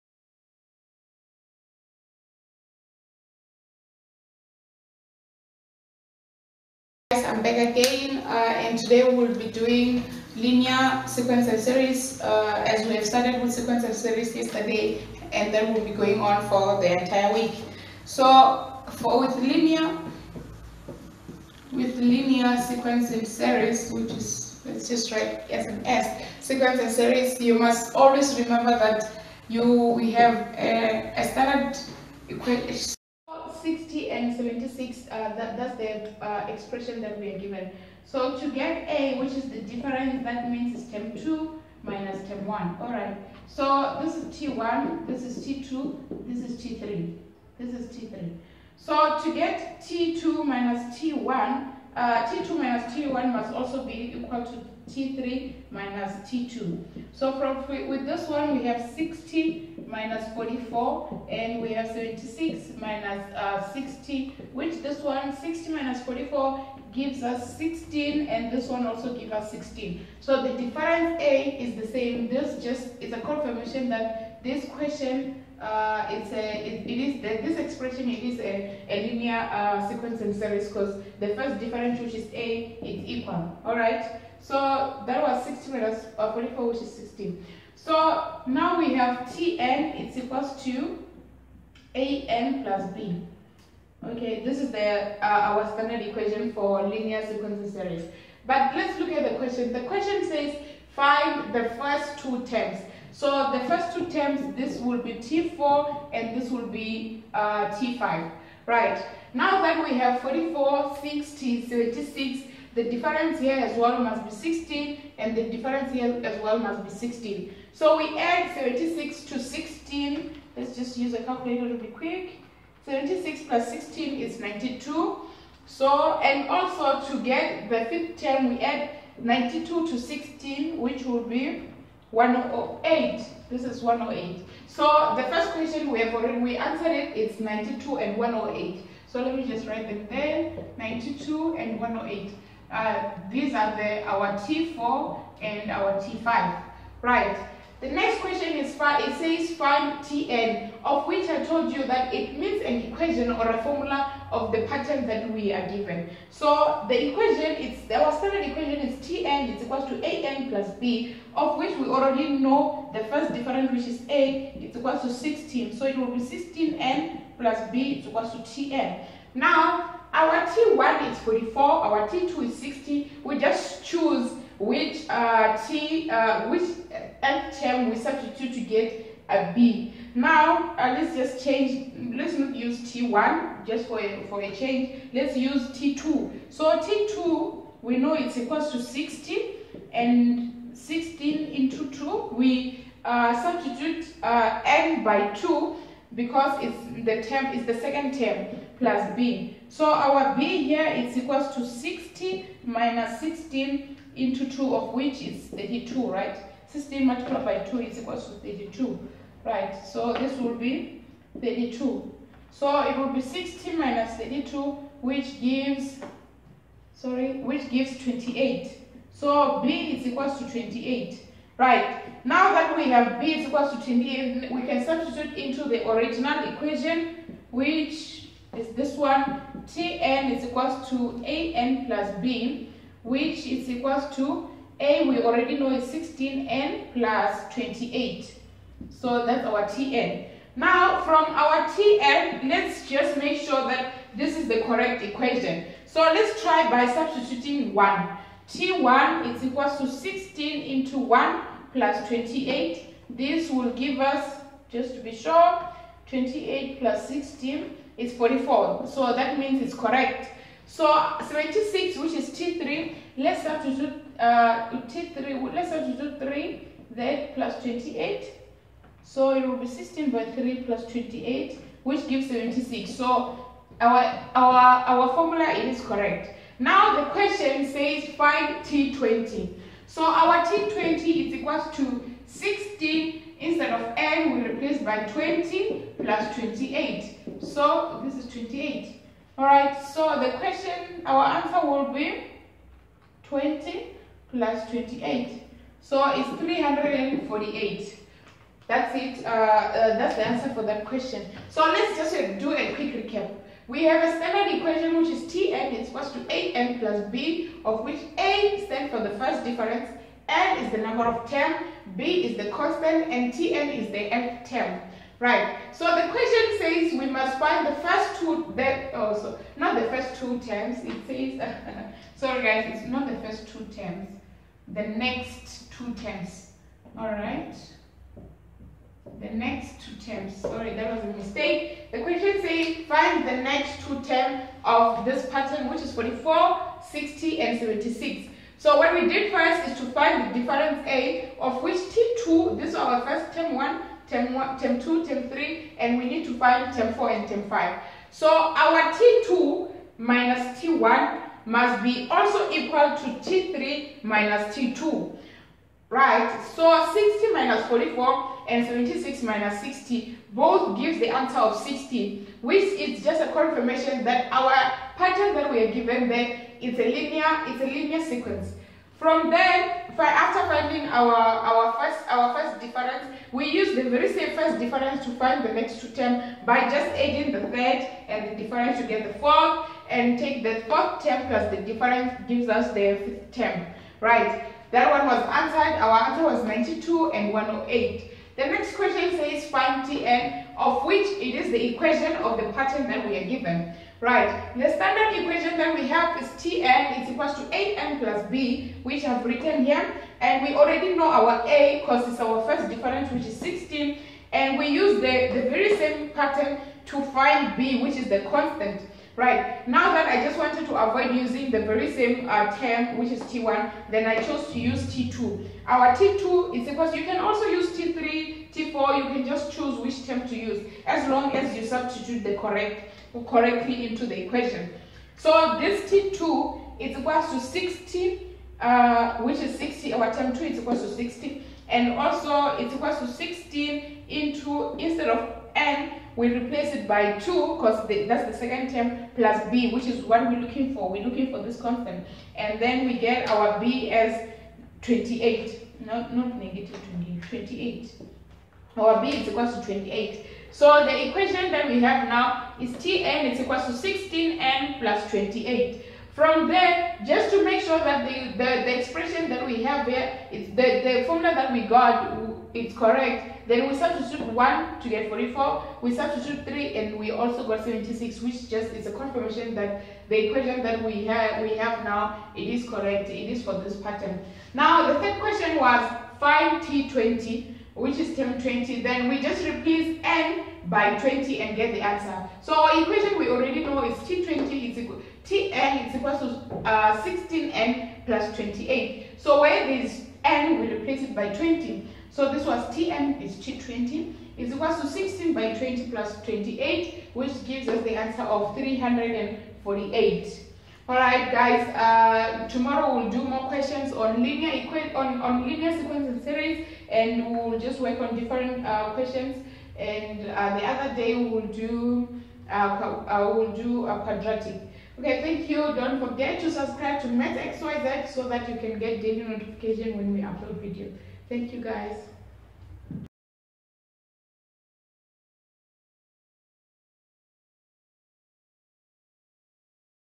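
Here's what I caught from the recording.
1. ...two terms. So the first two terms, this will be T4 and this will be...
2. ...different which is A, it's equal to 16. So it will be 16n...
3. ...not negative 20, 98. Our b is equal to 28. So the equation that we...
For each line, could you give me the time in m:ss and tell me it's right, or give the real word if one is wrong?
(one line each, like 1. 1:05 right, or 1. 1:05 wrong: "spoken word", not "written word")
1. 1:42 right
2. 2:43 right
3. 7:26 wrong: "28", not "98".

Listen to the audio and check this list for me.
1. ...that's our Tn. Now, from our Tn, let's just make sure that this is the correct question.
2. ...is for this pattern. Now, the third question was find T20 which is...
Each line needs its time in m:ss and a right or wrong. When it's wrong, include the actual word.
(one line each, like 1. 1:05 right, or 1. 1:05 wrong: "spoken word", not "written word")
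1. 3:59 wrong: "equation", not "question"
2. 7:53 right.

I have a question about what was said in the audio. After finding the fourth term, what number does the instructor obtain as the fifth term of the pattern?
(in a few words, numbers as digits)
108.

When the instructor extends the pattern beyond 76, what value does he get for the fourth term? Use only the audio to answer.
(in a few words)
92.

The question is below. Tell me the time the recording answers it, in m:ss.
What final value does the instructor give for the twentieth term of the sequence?
4:55.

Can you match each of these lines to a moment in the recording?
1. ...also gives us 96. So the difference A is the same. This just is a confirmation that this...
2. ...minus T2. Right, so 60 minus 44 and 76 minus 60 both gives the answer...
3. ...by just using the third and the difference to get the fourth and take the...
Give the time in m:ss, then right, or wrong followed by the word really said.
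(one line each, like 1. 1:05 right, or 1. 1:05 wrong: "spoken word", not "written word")
1. 1:08 wrong: "16", not "96"
2. 5:54 right
3. 6:16 wrong: "adding", not "using".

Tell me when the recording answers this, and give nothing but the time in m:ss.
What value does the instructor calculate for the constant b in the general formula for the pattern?
3:37.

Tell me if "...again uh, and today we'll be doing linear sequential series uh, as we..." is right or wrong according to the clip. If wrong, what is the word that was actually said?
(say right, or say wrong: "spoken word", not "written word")
right.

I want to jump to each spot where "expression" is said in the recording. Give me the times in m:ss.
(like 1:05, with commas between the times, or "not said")
0:36, 1:17, 7:38.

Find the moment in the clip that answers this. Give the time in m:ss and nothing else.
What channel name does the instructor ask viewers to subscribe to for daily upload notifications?
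8:37.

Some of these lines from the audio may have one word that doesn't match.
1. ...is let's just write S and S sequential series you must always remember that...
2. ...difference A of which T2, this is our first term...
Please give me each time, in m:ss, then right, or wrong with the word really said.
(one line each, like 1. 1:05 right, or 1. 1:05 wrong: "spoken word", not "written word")
1. 0:24 right
2. 5:40 right.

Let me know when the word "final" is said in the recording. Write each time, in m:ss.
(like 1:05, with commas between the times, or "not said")
not said.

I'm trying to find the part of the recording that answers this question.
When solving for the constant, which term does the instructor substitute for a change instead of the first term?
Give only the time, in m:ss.
3:05.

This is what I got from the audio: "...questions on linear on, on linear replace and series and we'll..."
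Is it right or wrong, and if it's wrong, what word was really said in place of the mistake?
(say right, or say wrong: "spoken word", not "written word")
wrong: "sequence", not "replace".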